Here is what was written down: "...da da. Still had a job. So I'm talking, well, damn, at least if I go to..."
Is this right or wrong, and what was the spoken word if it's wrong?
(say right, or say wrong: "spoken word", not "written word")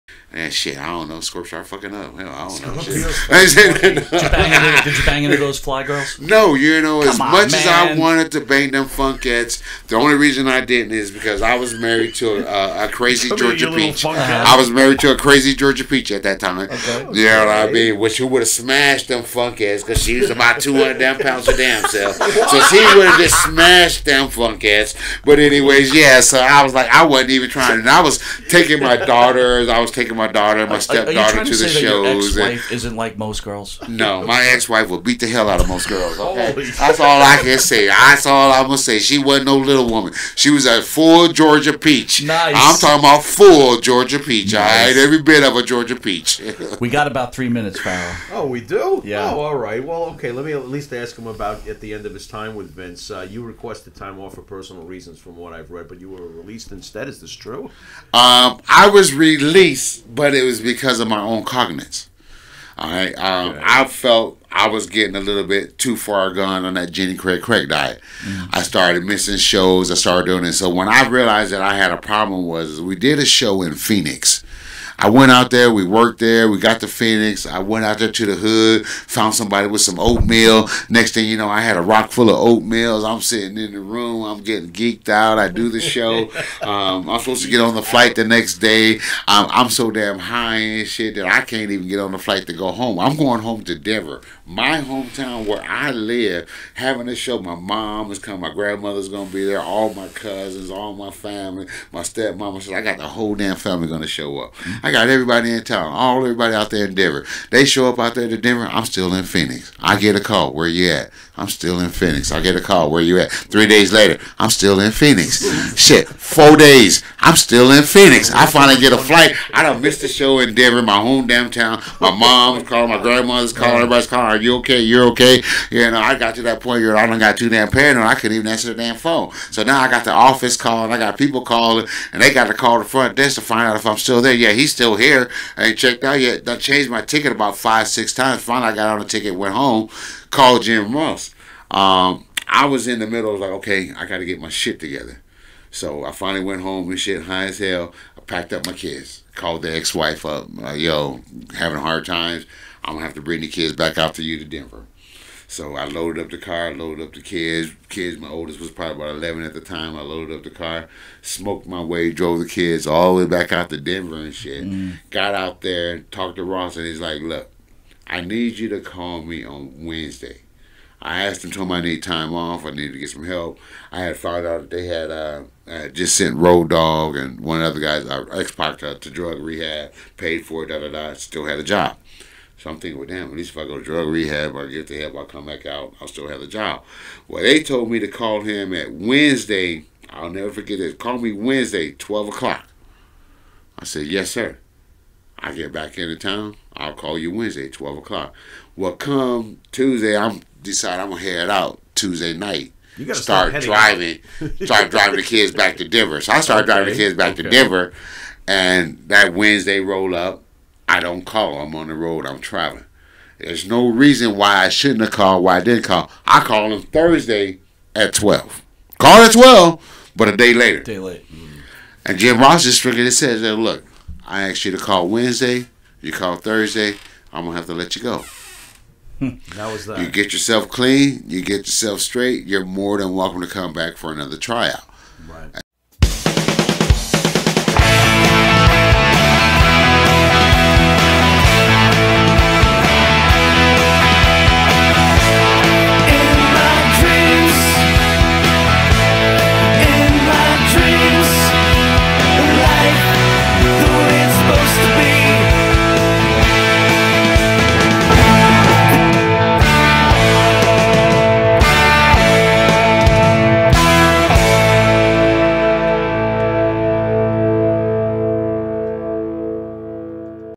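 wrong: "thinking", not "talking".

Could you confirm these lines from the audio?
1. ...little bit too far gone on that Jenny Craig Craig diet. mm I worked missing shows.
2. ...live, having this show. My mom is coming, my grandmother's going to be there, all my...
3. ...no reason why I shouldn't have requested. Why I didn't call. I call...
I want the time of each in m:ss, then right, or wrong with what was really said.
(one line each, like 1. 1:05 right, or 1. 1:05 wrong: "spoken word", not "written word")
1. 1:05 wrong: "started", not "worked"
2. 1:35 right
3. 3:33 wrong: "called", not "requested".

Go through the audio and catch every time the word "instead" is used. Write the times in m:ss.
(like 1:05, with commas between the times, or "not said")
0:56.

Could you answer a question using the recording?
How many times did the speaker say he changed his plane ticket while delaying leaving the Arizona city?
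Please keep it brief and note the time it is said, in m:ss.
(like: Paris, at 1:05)
5 or 6, at 2:17.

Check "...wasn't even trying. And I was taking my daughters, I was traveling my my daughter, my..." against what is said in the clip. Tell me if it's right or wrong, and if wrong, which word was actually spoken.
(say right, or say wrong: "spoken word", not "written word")
wrong: "taking", not "traveling".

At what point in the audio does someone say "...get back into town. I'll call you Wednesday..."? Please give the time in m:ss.
3:15.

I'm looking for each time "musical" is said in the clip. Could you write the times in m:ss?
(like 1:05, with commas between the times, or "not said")
not said.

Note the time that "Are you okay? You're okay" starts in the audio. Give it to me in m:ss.
2:04.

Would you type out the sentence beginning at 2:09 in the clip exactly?
So now I got the office calling.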